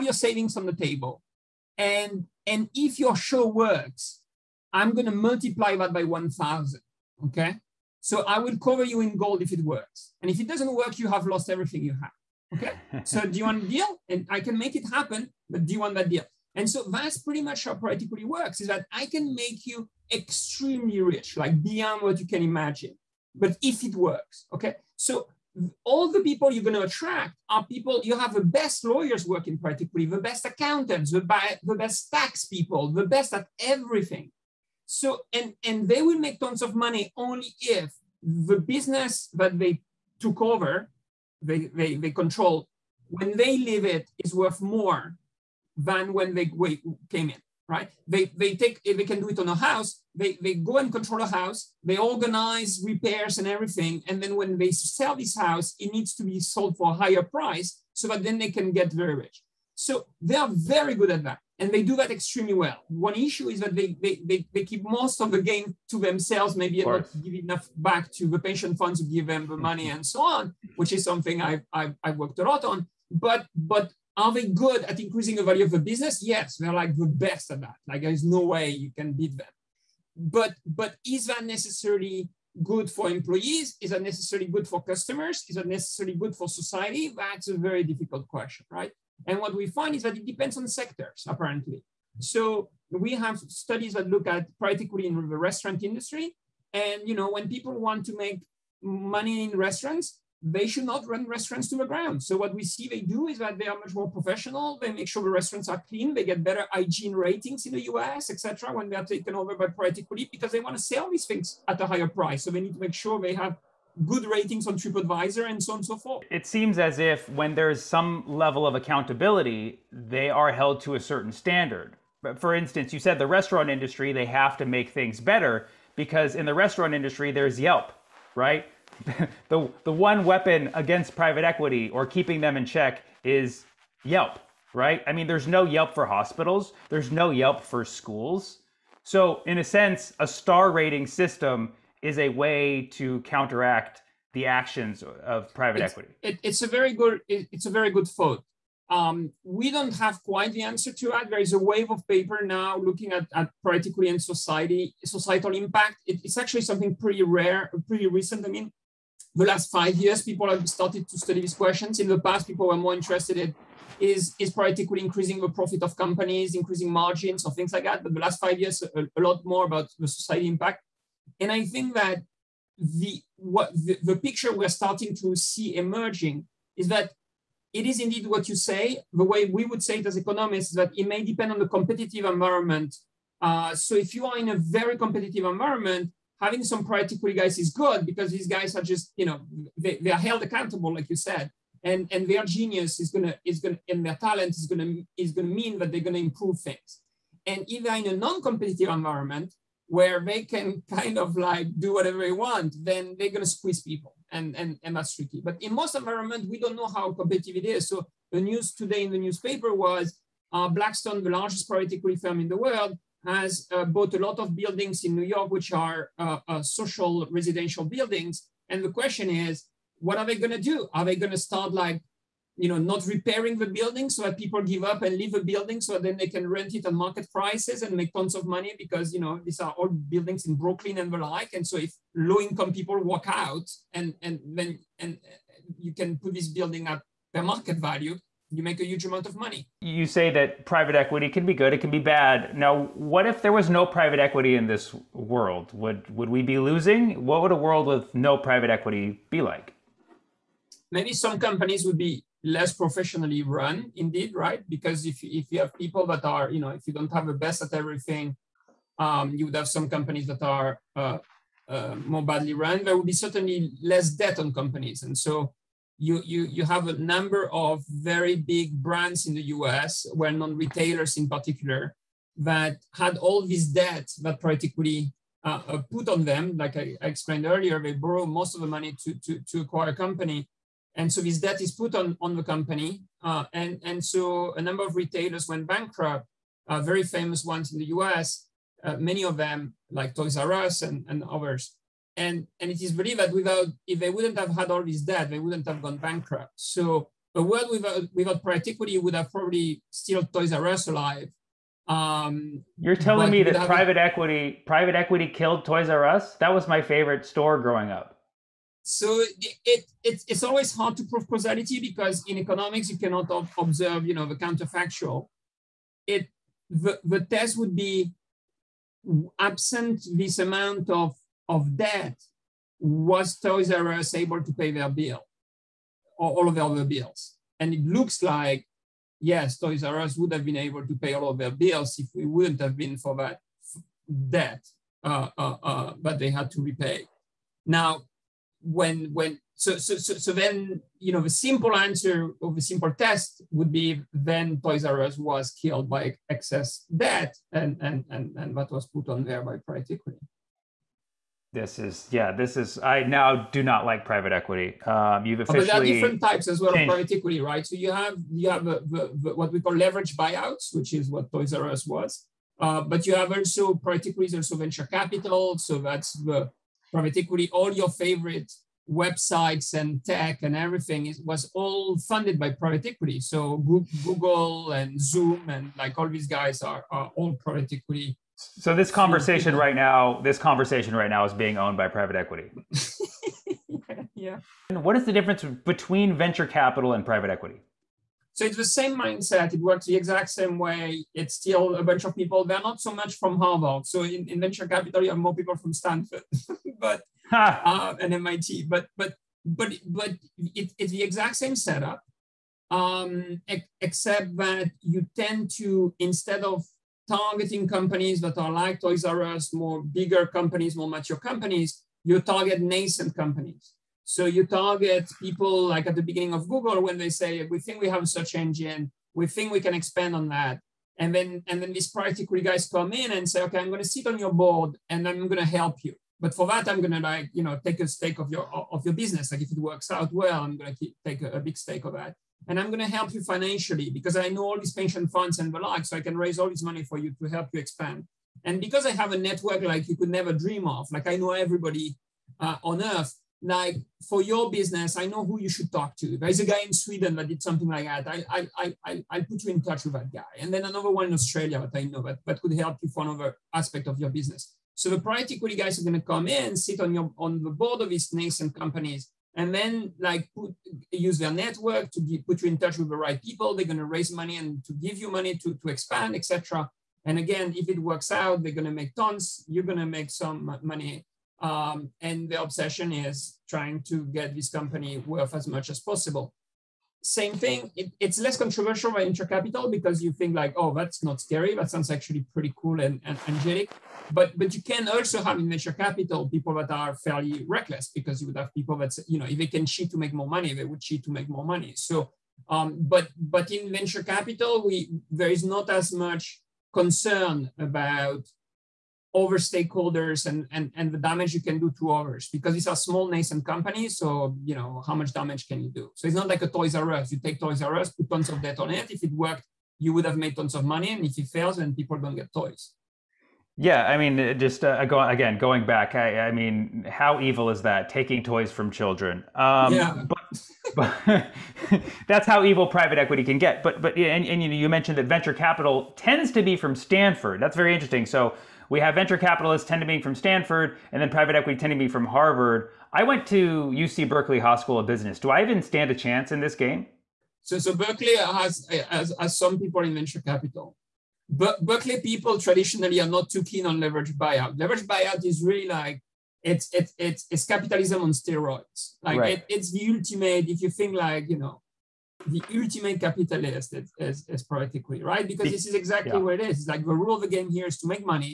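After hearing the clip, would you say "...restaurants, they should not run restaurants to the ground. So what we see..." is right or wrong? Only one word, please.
right.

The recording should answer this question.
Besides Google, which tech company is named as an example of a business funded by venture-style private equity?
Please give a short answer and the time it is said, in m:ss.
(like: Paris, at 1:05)
Zoom, at 6:14.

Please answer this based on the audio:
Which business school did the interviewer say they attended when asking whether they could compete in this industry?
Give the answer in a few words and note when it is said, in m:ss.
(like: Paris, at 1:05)
UC Berkeley Haas, at 8:53.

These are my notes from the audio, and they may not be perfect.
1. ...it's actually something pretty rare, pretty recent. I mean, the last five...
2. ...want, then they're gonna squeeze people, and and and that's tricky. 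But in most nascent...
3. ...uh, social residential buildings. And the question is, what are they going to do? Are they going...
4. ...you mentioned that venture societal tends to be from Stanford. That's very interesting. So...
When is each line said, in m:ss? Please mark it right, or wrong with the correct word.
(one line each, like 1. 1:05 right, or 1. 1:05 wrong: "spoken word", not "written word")
1. 2:36 right
2. 3:22 wrong: "environment", not "nascent"
3. 3:36 right
4. 8:44 wrong: "capital", not "societal".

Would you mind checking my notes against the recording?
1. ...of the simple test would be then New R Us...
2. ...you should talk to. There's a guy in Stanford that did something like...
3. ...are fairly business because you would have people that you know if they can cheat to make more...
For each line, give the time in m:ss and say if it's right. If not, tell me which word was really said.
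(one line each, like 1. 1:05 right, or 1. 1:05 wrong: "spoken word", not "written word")
1. 5:42 wrong: "Toys", not "New"
2. 7:25 wrong: "Sweden", not "Stanford"
3. 8:06 wrong: "reckless", not "business".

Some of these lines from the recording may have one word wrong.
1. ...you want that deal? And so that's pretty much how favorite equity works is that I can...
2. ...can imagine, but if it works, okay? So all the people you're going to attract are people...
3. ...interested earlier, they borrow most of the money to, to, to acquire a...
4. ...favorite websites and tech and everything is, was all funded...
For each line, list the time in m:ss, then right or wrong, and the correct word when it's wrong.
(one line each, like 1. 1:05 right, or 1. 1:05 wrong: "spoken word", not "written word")
1. 0:15 wrong: "private", not "favorite"
2. 0:22 right
3. 4:36 wrong: "explained", not "interested"
4. 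6:07 right.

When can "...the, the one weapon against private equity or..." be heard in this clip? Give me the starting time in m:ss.
2:09.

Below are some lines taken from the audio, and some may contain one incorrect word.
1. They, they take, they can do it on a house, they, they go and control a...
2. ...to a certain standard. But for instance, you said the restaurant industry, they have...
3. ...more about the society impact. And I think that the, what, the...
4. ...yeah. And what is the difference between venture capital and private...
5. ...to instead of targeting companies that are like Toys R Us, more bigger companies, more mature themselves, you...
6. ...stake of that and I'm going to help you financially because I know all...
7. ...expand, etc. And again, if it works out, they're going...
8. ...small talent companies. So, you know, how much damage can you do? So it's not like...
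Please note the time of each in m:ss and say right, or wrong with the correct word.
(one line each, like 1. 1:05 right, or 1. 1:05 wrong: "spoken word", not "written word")
1. 0:48 right
2. 2:00 right
3. 2:49 right
4. 6:24 right
5. 6:45 wrong: "companies", not "themselves"
6. 7:11 right
7. 7:45 right
8. 8:22 wrong: "nascent", not "talent".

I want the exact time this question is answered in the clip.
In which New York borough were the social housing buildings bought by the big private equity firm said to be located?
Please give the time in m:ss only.
3:50.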